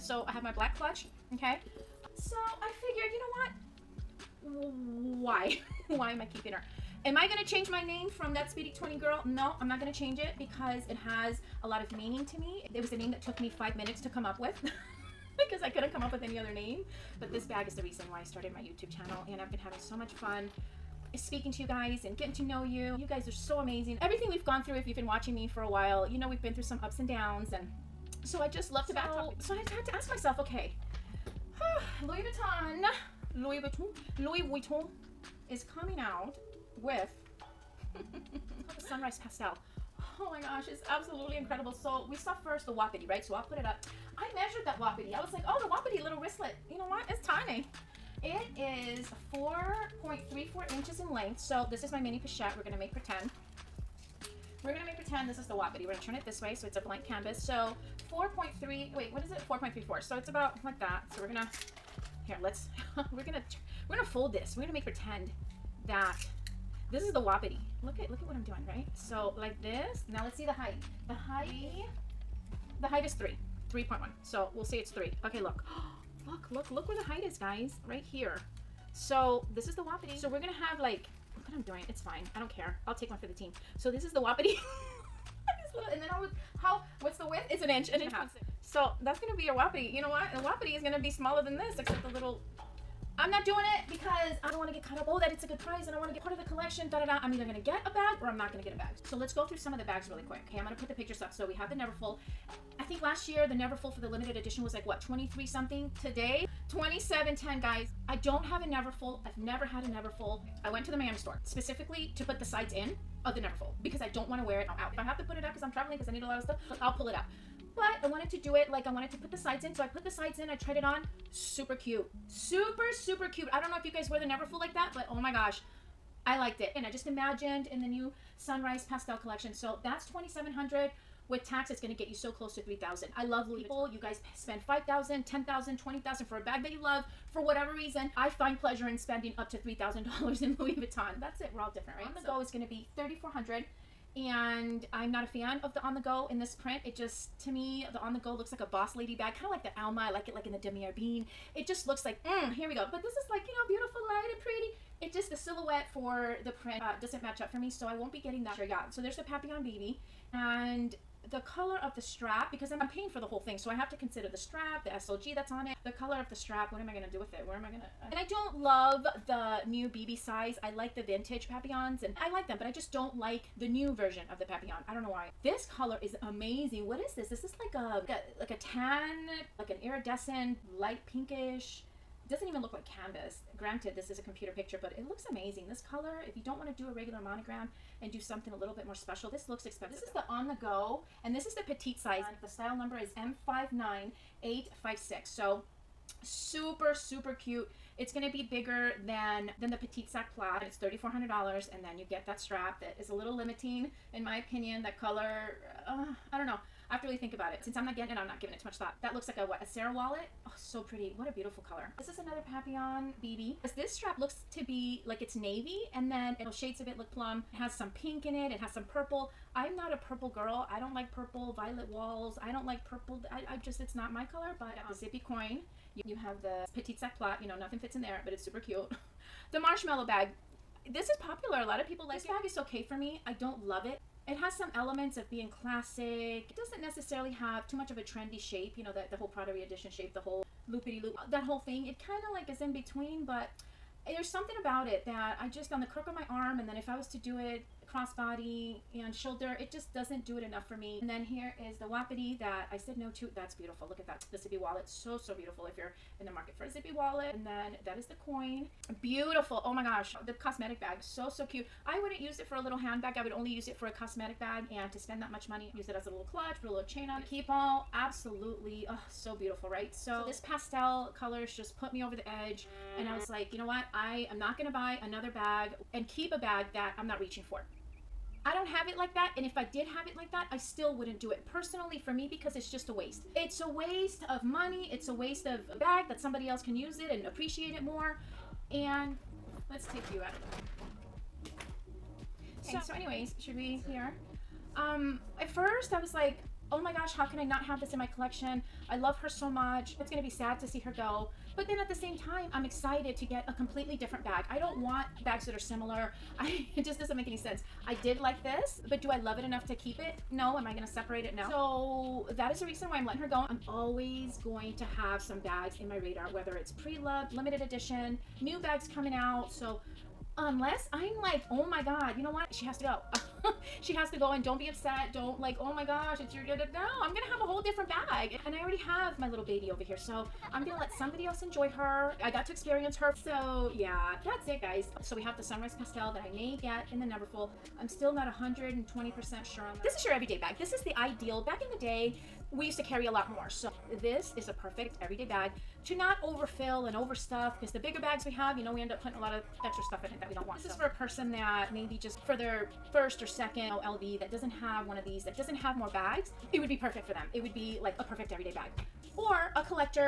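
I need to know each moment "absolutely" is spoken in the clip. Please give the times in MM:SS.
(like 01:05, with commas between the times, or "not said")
00:40, 04:27.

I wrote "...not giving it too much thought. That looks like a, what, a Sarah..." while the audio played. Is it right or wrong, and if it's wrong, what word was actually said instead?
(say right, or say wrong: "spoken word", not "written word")
right.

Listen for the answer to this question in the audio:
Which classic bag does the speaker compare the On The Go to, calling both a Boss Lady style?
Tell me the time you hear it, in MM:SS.
02:29.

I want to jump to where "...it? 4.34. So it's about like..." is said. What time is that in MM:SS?
00:59.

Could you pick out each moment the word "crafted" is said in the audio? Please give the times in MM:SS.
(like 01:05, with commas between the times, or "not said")
not said.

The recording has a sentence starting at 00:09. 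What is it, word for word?
No, I'm not gonna change it because it has a lot of meaning to me.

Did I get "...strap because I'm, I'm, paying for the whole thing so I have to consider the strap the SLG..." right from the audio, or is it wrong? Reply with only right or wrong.
right.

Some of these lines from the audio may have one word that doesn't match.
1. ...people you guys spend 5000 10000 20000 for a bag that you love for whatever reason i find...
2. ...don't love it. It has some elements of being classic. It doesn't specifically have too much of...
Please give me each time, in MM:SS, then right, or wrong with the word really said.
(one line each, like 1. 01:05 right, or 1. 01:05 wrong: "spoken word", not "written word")
1. 02:13 right
2. 03:53 wrong: "necessarily", not "specifically".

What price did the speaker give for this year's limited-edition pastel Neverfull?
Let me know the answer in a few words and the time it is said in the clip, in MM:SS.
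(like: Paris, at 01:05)
27.10, at 01:46.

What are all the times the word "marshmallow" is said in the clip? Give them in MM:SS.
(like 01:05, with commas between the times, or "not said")
03:49.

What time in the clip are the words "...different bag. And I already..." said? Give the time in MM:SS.
05:27.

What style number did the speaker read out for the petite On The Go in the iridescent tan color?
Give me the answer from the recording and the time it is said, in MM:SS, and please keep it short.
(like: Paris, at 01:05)
M59856, at 03:14.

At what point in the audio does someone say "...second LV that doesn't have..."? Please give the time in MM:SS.
05:53.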